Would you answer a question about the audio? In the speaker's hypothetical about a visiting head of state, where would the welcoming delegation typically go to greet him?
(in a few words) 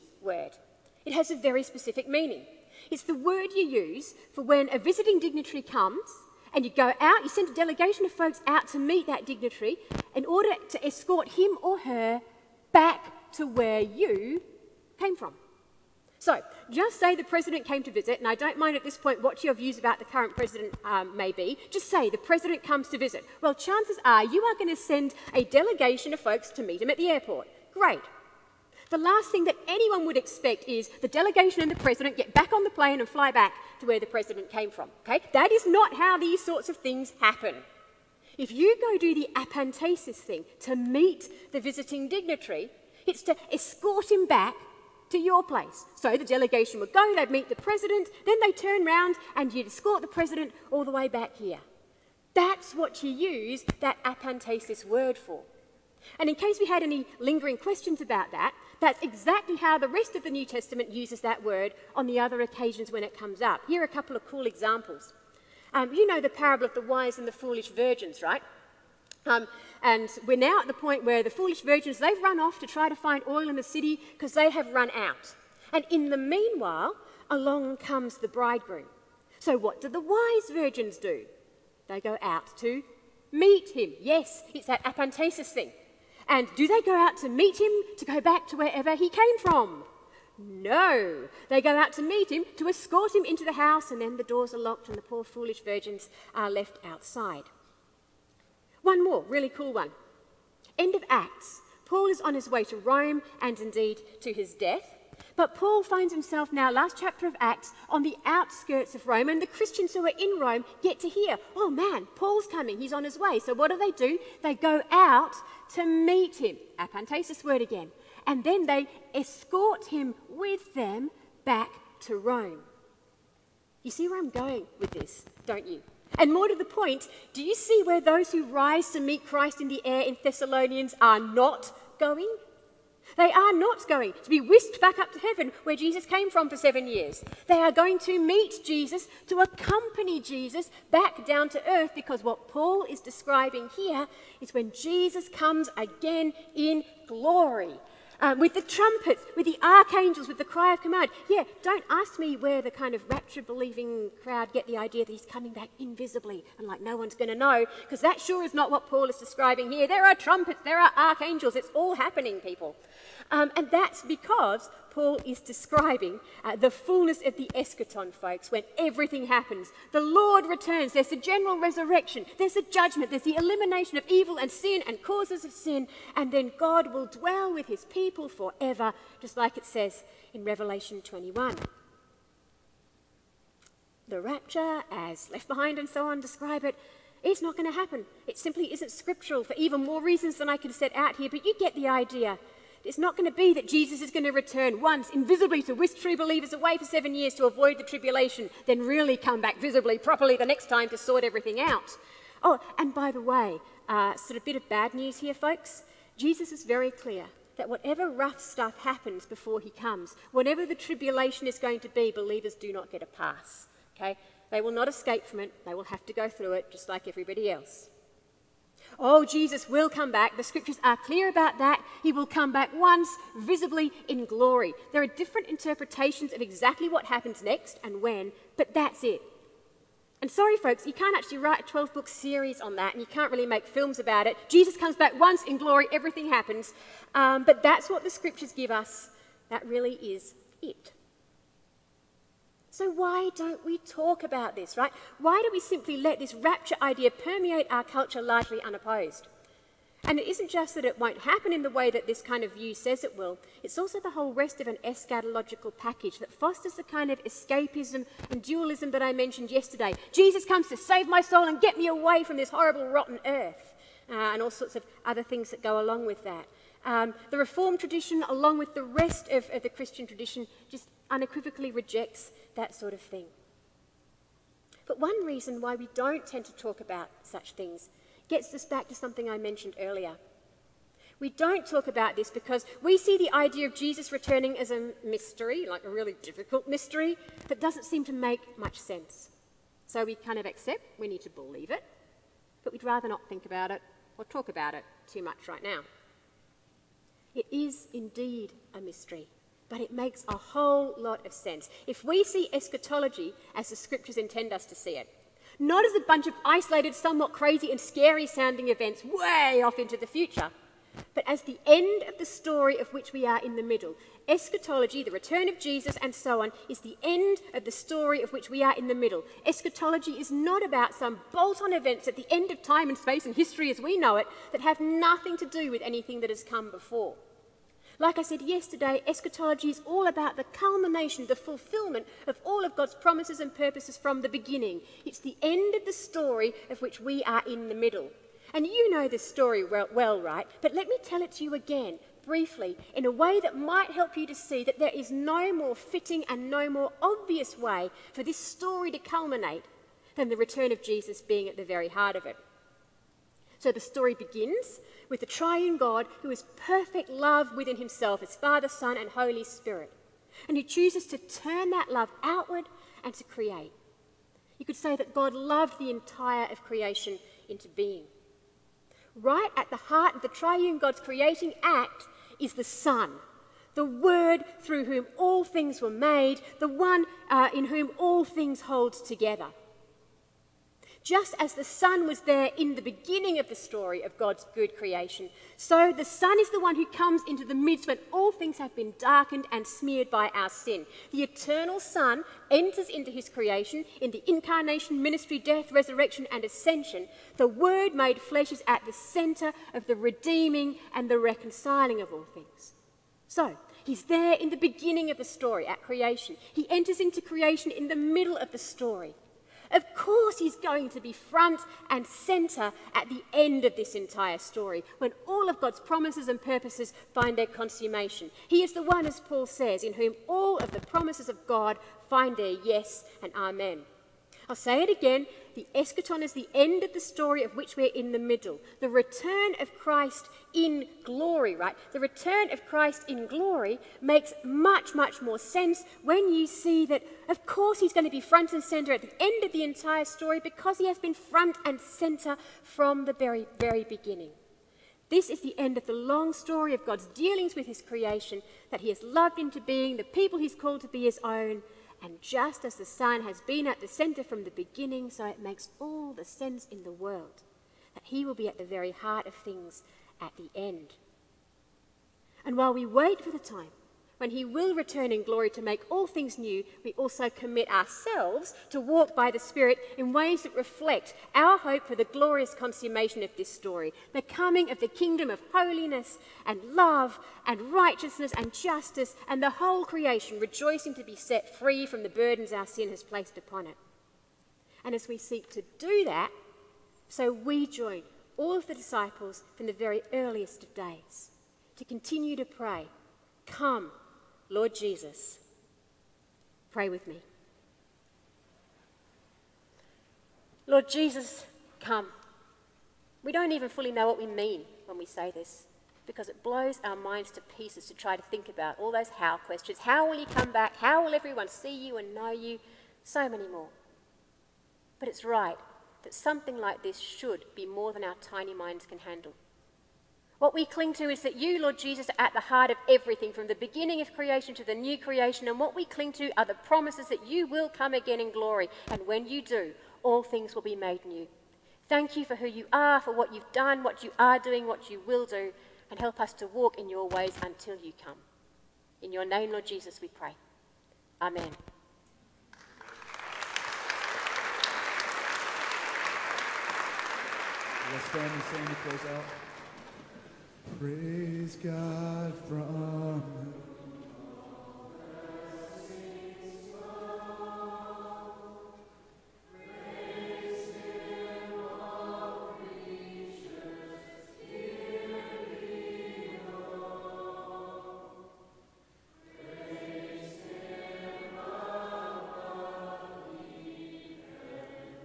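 the airport.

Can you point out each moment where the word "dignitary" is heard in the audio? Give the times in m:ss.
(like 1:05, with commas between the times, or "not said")
0:05, 0:09, 0:42.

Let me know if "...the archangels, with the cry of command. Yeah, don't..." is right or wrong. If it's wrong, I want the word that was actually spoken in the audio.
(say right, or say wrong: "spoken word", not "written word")
right.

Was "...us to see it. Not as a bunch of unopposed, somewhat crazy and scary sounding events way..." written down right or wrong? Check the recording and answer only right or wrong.
wrong.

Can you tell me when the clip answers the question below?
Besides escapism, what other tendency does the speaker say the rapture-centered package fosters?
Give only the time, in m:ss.
4:18.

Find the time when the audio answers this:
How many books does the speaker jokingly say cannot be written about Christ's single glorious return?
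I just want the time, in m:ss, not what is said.
3:51.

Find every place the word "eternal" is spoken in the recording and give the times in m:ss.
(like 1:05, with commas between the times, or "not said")
6:31.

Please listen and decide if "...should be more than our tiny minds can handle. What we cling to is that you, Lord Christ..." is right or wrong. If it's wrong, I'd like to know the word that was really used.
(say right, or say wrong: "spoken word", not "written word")
wrong: "Jesus", not "Christ".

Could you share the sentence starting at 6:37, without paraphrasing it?
The Word made flesh is at the centre of the redeeming and the reconciling of all things.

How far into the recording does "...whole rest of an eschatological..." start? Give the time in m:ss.
4:14.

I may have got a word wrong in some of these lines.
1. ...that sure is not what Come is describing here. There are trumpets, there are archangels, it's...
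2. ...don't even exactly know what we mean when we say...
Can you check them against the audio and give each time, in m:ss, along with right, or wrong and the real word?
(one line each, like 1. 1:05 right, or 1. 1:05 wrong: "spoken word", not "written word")
1. 2:37 wrong: "Paul", not "Come"
2. 8:23 wrong: "fully", not "exactly".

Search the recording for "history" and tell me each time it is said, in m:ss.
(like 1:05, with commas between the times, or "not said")
5:23.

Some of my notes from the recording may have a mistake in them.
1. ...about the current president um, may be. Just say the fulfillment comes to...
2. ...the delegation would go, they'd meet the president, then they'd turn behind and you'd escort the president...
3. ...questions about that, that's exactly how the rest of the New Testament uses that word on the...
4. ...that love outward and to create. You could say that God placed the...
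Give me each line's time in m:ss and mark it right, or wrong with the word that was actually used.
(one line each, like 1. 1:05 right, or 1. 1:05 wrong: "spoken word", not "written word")
1. 0:19 wrong: "president", not "fulfillment"
2. 0:46 wrong: "round", not "behind"
3. 0:57 right
4. 6:01 wrong: "loved", not "placed".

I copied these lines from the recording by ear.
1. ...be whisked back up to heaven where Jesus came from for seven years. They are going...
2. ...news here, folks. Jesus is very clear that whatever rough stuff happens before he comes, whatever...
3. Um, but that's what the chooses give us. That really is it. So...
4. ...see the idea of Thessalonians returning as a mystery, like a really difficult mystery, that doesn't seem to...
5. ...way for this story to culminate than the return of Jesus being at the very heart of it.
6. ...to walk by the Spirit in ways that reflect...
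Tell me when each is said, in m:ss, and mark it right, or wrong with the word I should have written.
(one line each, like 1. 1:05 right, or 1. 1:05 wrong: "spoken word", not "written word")
1. 2:14 right
2. 3:24 right
3. 3:57 wrong: "scriptures", not "chooses"
4. 4:42 wrong: "Jesus", not "Thessalonians"
5. 5:47 right
6. 7:48 right.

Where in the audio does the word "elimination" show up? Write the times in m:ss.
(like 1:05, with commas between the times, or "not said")
2:53.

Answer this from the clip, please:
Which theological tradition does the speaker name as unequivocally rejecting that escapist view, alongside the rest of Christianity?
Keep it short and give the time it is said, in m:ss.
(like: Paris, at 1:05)
the Reformed tradition, at 4:27.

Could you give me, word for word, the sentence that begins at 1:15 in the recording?
And in the meanwhile, along comes the bridegroom.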